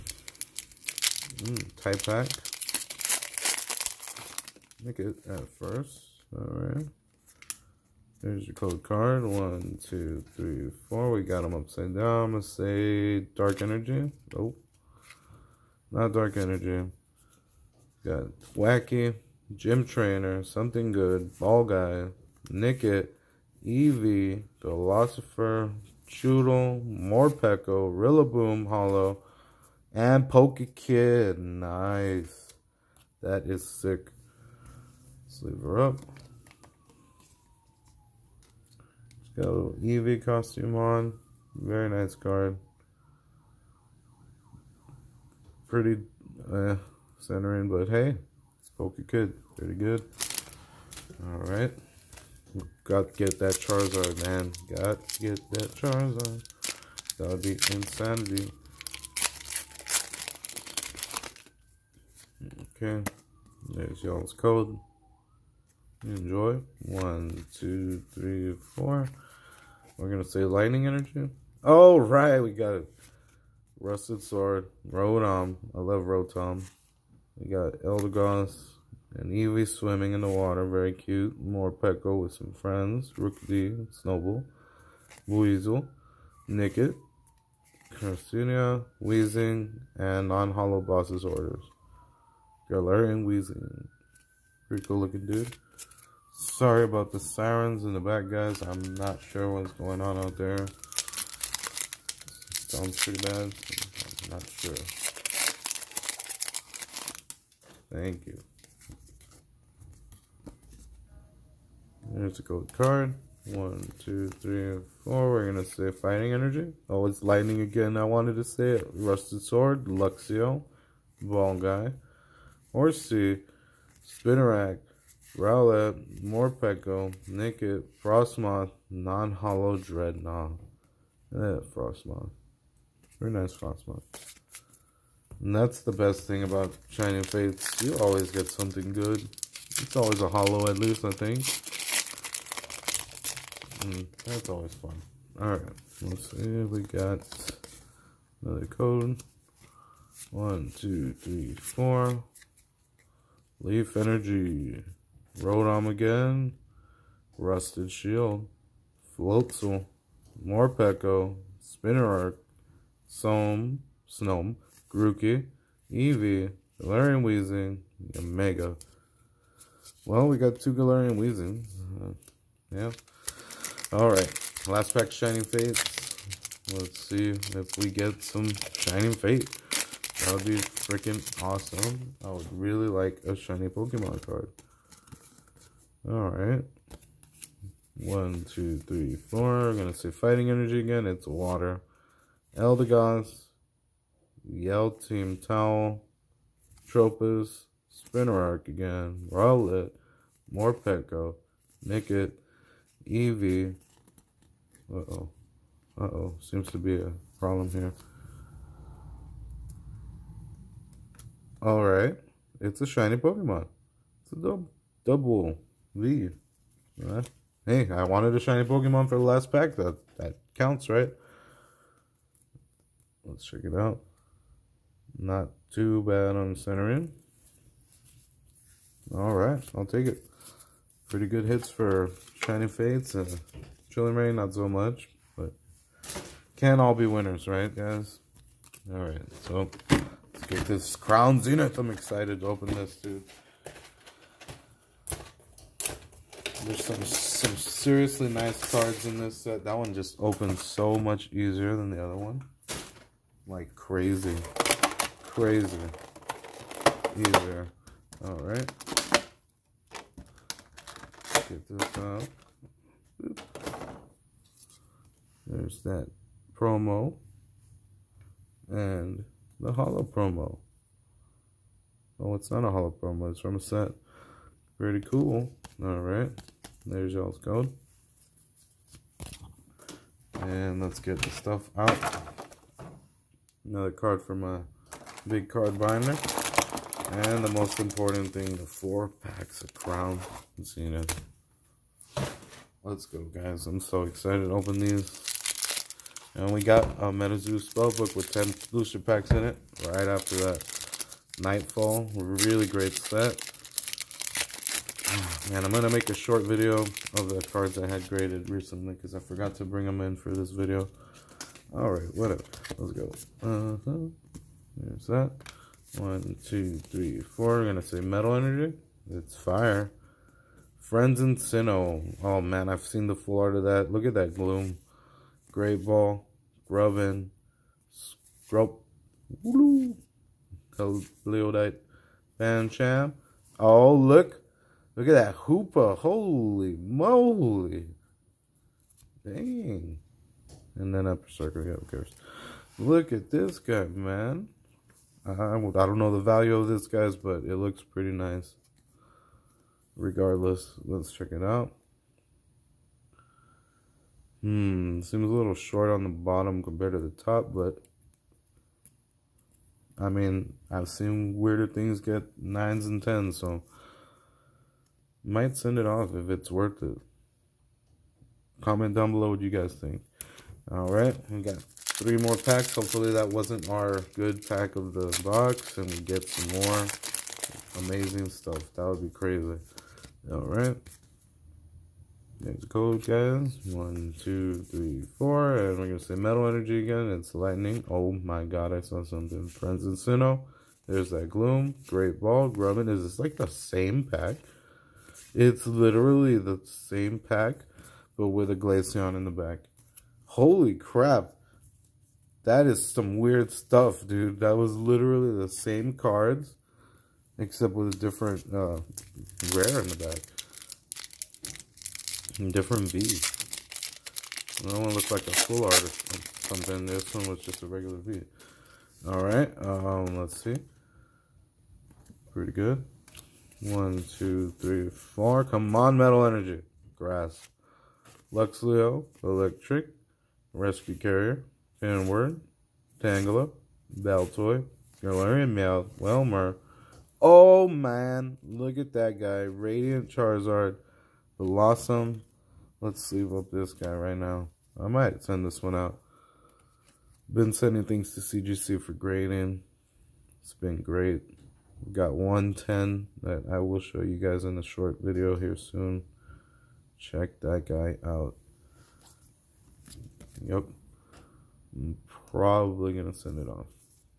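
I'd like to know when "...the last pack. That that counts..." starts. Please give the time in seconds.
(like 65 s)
219 s.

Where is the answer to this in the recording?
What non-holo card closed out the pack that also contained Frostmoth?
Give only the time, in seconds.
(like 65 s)
128 s.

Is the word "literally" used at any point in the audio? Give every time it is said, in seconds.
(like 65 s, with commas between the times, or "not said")
395 s, 404 s.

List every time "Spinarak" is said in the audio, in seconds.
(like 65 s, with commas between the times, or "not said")
124 s, 161 s.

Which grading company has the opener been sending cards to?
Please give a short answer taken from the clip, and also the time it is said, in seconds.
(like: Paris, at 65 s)
CGC, at 448 s.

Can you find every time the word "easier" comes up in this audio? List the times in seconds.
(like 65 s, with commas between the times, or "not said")
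251 s, 257 s.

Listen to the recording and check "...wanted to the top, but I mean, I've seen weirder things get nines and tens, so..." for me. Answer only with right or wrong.
wrong.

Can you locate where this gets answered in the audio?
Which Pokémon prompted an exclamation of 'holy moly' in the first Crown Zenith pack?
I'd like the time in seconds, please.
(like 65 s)
335 s.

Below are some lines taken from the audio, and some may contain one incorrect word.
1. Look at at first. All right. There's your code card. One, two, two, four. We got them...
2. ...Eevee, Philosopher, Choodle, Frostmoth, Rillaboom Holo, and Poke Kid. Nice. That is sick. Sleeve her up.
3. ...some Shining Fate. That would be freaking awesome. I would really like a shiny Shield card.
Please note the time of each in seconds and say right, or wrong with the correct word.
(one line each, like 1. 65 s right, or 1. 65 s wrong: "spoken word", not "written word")
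1. 4 s wrong: "three", not "two"
2. 23 s wrong: "Morpeko", not "Frostmoth"
3. 178 s wrong: "Pokemon", not "Shield".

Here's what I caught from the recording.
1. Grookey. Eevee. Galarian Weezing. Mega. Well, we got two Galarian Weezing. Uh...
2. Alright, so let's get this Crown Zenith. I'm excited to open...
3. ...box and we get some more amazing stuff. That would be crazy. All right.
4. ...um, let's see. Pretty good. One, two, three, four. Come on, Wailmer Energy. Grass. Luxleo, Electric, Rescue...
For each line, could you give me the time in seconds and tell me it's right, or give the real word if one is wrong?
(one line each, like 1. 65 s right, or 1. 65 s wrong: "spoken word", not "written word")
1. 164 s right
2. 238 s right
3. 375 s right
4. 419 s wrong: "Metal", not "Wailmer".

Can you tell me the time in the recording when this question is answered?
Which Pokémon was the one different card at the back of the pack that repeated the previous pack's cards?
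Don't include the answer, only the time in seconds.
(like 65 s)
398 s.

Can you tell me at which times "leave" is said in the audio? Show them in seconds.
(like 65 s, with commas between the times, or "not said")
215 s.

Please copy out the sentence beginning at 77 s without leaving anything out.
We got Eldegoss and Eevee swimming in the water.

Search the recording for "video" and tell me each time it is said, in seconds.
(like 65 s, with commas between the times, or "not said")
306 s, 310 s, 455 s.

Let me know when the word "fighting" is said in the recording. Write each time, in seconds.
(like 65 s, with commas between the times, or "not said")
115 s, 190 s.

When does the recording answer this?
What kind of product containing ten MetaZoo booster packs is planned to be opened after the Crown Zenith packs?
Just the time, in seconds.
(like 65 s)
297 s.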